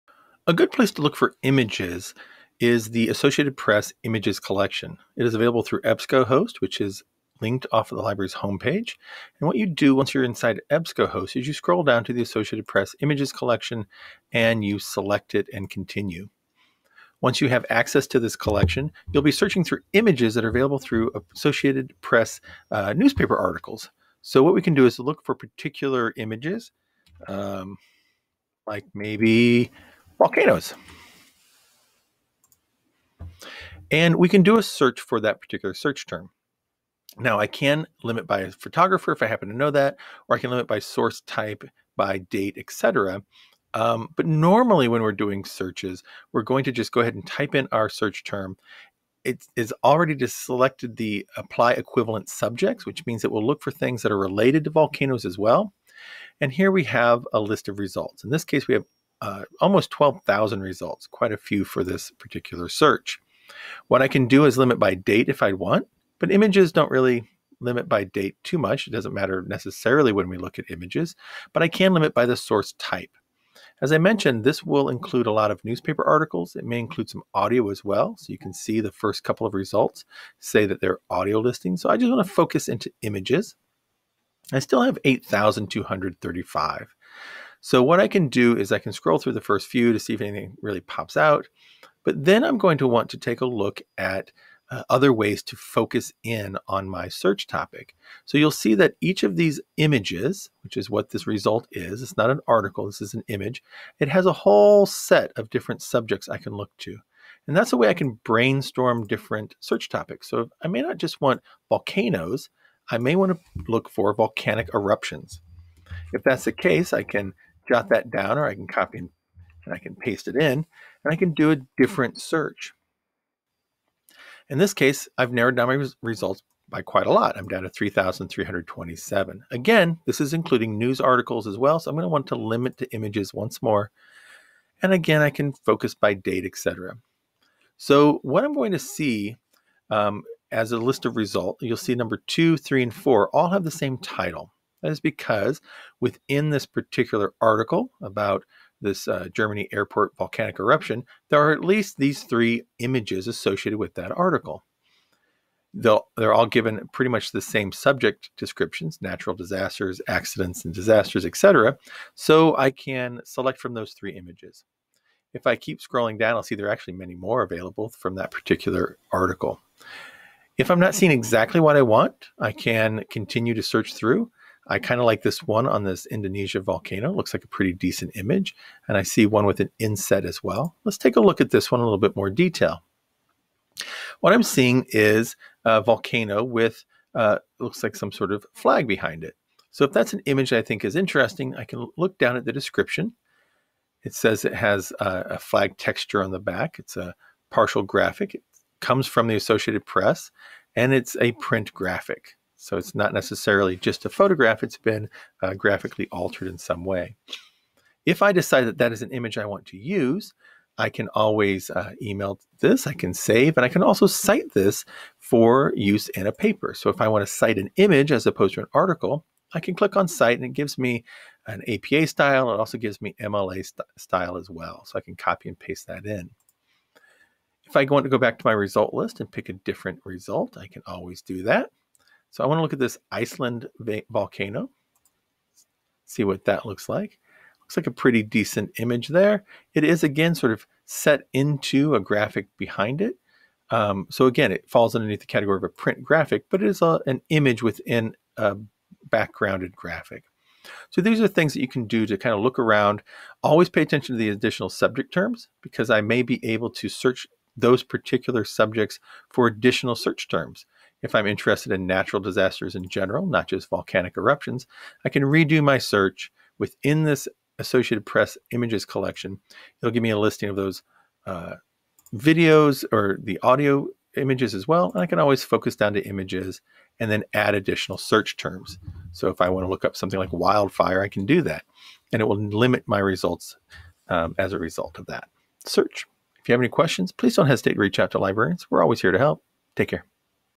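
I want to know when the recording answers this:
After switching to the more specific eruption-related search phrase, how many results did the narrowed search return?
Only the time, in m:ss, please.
2:07.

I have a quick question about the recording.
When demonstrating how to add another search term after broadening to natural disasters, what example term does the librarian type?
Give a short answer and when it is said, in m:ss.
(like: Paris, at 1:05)
wildfire, at 4:40.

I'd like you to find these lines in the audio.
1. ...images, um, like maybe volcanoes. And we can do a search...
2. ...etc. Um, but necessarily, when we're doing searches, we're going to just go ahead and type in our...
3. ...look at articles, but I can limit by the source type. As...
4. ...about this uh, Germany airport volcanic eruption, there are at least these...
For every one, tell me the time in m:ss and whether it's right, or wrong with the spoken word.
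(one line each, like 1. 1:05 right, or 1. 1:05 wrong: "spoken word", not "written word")
1. 0:26 right
2. 0:42 wrong: "normally", not "necessarily"
3. 1:10 wrong: "images", not "articles"
4. 2:28 right.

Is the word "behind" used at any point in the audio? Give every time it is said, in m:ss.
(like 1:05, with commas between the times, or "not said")
3:08, 4:02.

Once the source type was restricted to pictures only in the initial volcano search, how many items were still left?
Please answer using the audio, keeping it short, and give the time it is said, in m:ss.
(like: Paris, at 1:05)
8,235, at 1:25.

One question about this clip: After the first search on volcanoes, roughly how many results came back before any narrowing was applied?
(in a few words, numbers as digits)
almost 12,000.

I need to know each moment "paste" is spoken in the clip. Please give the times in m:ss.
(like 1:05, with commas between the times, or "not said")
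1:59, 3:45.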